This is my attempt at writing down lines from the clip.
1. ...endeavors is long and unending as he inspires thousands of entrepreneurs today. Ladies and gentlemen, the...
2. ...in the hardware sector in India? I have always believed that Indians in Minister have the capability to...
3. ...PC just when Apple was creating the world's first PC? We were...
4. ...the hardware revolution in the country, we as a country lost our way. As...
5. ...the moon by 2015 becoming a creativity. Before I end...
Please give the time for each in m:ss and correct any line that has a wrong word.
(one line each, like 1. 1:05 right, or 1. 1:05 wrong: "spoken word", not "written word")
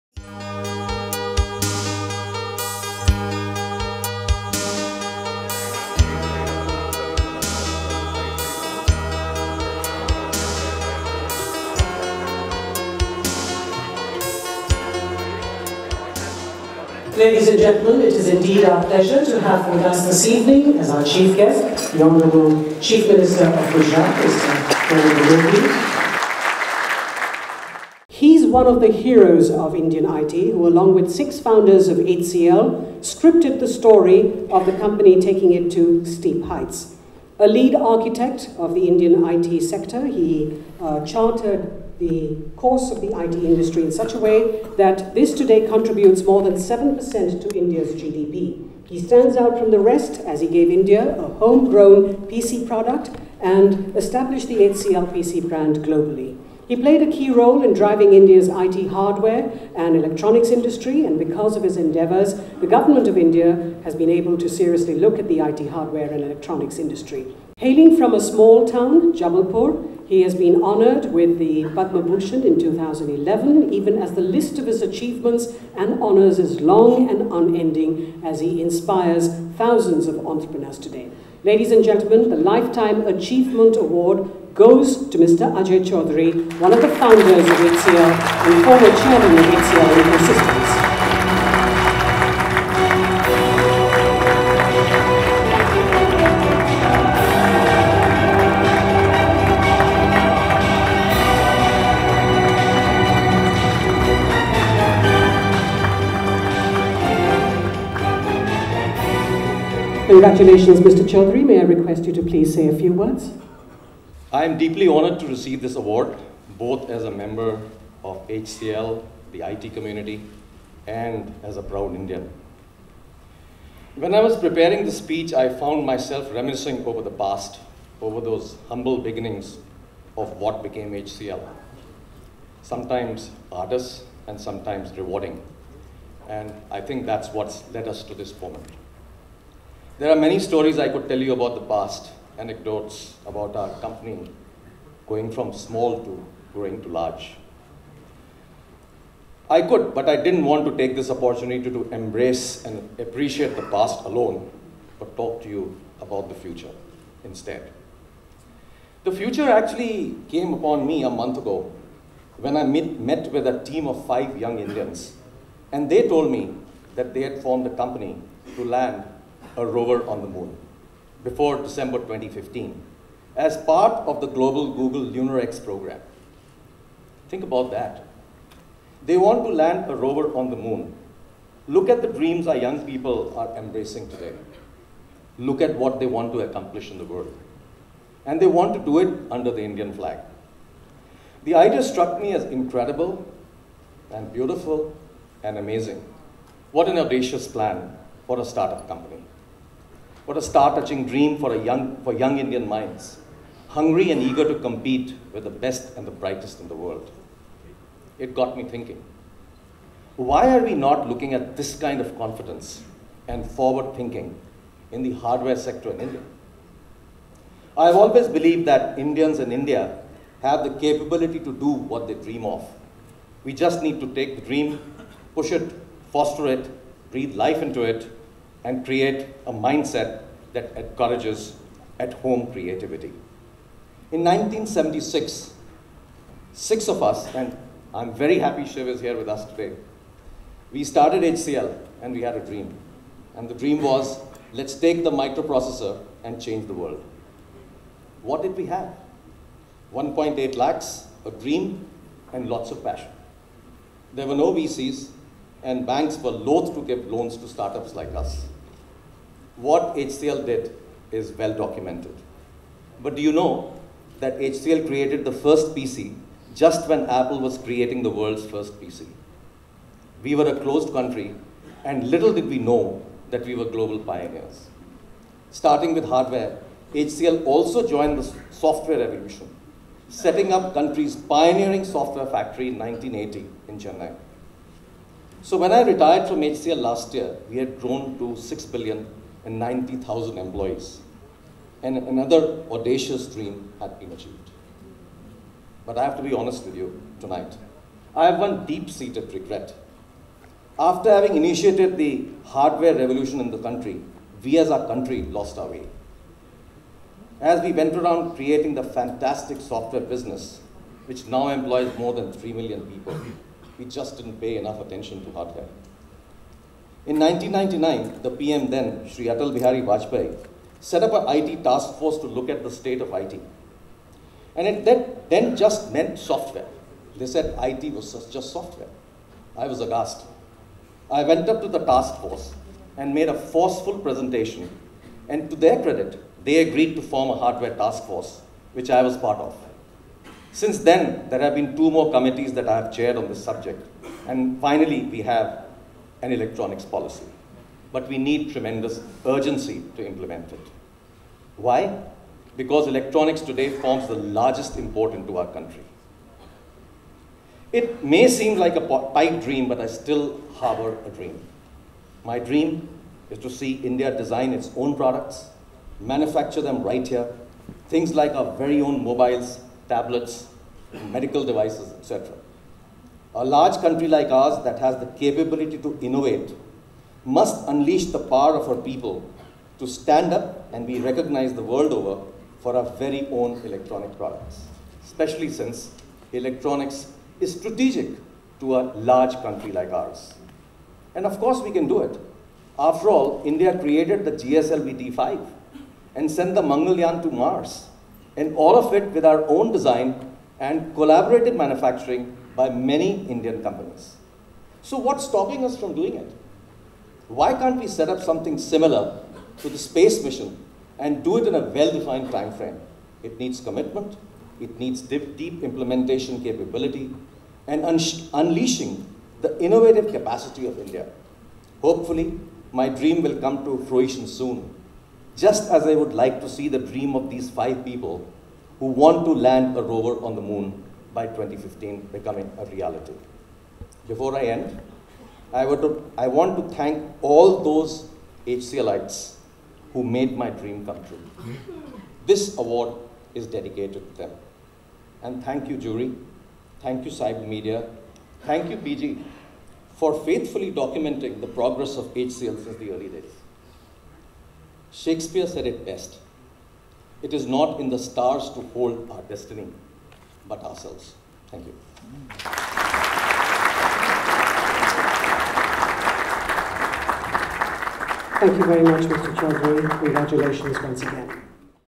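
1. 1:16 wrong: "honors", not "endeavors"
2. 3:34 wrong: "India", not "Minister"
3. 4:25 right
4. 5:01 right
5. 7:10 wrong: "reality", not "creativity".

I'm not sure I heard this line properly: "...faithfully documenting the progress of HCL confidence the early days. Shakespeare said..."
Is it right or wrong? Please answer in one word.
wrong.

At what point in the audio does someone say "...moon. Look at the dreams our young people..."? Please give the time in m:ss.
3:00.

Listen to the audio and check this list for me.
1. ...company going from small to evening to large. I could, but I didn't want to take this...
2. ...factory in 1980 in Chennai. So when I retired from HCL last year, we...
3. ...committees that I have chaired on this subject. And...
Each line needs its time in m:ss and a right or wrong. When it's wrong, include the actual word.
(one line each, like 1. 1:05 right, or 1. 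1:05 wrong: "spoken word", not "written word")
1. 2:23 wrong: "growing", not "evening"
2. 4:42 right
3. 5:42 right.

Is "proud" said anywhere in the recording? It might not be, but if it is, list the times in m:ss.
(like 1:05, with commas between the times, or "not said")
2:01.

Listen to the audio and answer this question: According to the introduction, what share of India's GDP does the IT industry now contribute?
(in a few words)
more than 7%.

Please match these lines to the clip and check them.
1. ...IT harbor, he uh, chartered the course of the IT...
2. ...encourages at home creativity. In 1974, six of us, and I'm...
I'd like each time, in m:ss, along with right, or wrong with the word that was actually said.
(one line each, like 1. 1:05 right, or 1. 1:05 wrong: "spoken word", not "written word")
1. 0:39 wrong: "sector", not "harbor"
2. 3:50 wrong: "1976", not "1974".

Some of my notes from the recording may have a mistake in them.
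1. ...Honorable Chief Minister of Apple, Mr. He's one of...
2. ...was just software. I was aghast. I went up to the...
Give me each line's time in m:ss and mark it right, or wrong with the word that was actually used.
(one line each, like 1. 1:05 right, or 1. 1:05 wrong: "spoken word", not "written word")
1. 0:22 wrong: "Gujarat", not "Apple"
2. 5:27 right.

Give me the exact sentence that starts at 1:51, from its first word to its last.
May I request you to please say a few words?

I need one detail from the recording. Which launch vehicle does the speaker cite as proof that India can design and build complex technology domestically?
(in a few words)
GSLV D5.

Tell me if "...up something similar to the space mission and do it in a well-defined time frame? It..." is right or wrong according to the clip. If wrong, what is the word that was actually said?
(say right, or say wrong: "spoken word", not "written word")
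right.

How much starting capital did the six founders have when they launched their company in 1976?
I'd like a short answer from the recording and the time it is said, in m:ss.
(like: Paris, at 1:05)
1.8 lakhs, at 4:09.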